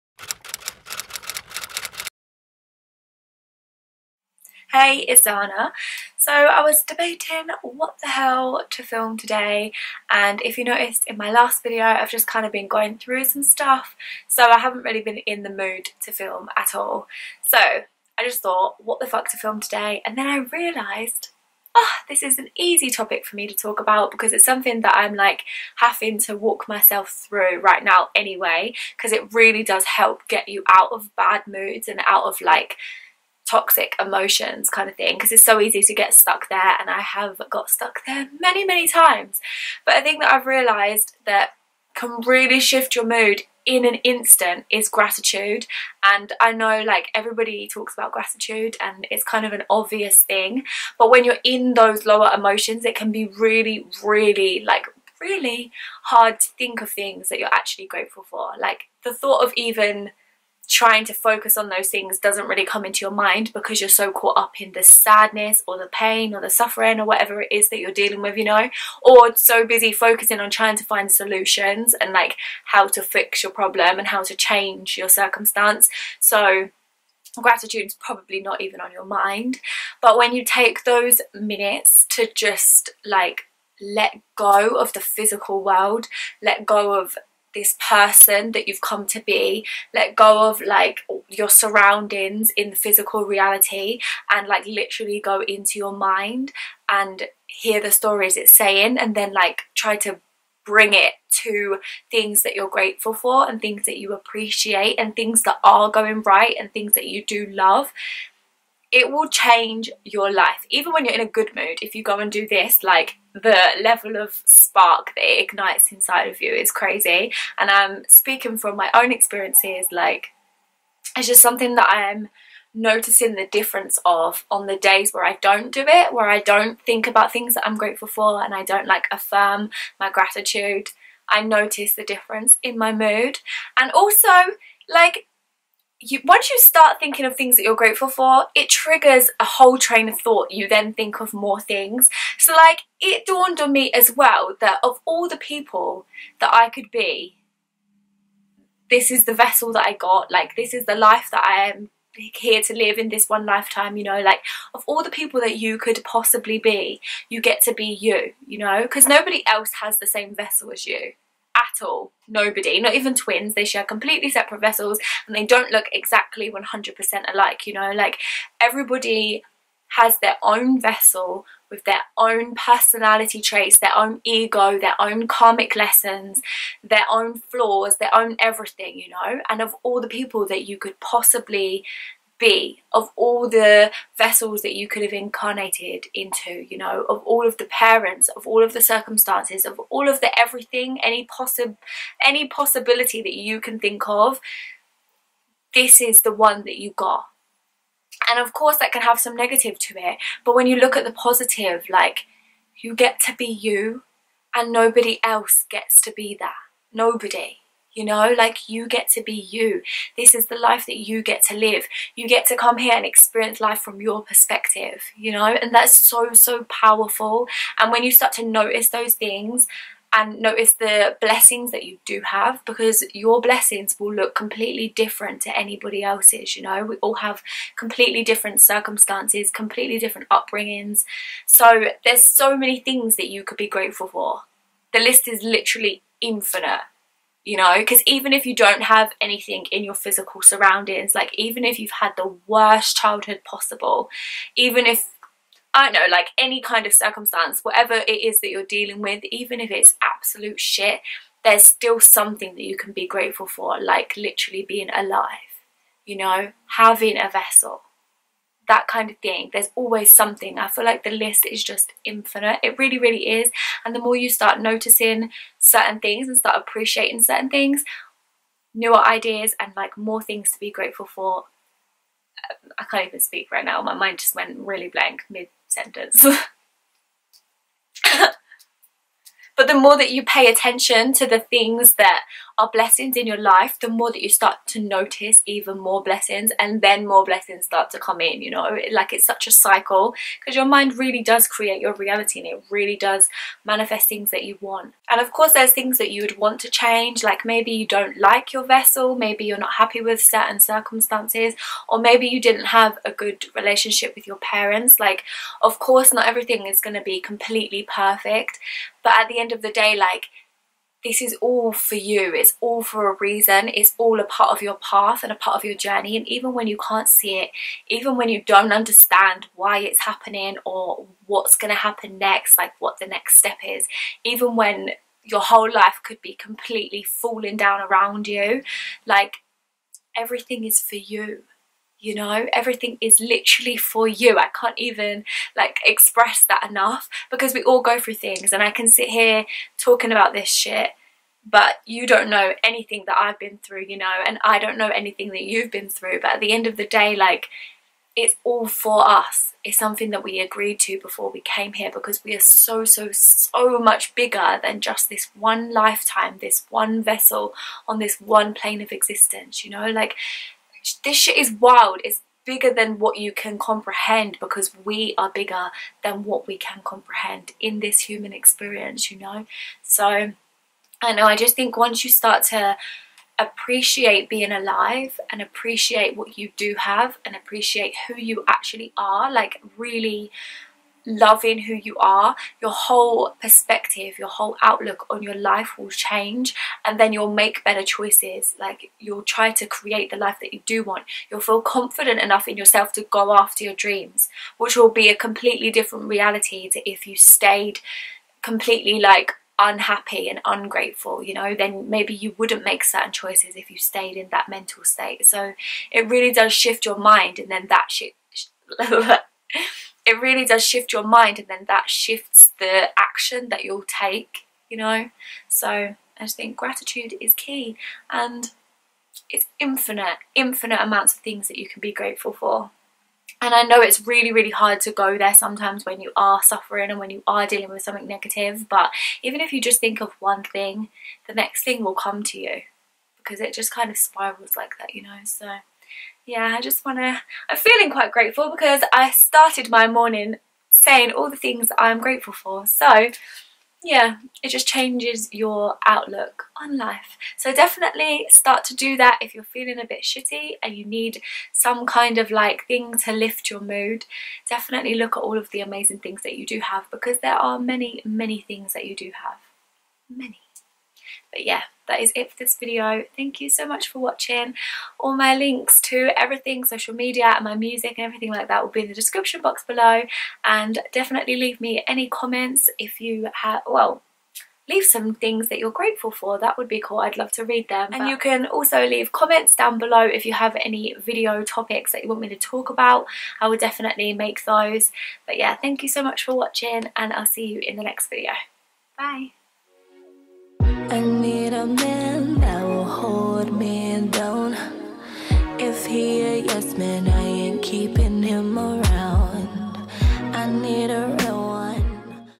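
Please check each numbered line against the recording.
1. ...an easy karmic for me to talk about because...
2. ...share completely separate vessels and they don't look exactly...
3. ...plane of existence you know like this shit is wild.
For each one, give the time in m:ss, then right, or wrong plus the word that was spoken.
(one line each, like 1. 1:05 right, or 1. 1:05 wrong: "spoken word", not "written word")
1. 0:22 wrong: "topic", not "karmic"
2. 2:43 right
3. 5:58 right.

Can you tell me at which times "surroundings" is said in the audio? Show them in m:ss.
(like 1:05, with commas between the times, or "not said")
1:31, 4:00.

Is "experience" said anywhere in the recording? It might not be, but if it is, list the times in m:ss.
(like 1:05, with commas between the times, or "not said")
1:59, 3:33, 6:08.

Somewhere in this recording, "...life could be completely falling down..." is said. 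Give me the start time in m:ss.
5:25.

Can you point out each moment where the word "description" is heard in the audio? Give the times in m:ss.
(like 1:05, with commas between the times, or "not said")
7:48.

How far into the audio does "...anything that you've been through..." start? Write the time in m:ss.
5:44.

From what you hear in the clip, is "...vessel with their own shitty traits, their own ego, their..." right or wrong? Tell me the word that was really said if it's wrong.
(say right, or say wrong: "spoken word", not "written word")
wrong: "personality", not "shitty".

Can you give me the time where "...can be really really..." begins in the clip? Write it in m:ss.
0:52.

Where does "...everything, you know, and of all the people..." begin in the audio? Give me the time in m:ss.
2:58.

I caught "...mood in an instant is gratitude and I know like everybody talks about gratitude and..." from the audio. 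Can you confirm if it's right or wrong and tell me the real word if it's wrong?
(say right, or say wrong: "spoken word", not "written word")
right.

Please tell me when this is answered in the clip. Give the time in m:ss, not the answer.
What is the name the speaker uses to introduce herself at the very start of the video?
0:05.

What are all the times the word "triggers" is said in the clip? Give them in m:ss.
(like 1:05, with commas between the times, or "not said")
2:18.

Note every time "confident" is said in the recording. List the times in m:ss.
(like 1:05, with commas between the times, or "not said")
6:31.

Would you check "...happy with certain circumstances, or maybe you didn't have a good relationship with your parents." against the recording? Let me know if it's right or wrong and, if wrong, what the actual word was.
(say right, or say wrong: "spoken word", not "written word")
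right.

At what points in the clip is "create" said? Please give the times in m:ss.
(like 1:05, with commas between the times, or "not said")
4:51, 6:29.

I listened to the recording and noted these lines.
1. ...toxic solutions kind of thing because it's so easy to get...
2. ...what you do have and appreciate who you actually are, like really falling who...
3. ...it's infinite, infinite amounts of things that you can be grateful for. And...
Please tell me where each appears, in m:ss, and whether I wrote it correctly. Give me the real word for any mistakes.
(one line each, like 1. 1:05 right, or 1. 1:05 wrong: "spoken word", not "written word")
1. 0:33 wrong: "emotions", not "solutions"
2. 6:16 wrong: "loving", not "falling"
3. 6:59 right.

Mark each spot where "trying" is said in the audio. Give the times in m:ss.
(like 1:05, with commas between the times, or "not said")
1:00, 1:10.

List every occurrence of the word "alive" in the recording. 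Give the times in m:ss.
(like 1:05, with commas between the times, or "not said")
4:14, 6:14.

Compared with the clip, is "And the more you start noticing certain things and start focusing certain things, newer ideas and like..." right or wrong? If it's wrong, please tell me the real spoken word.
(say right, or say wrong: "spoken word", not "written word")
wrong: "appreciating", not "focusing".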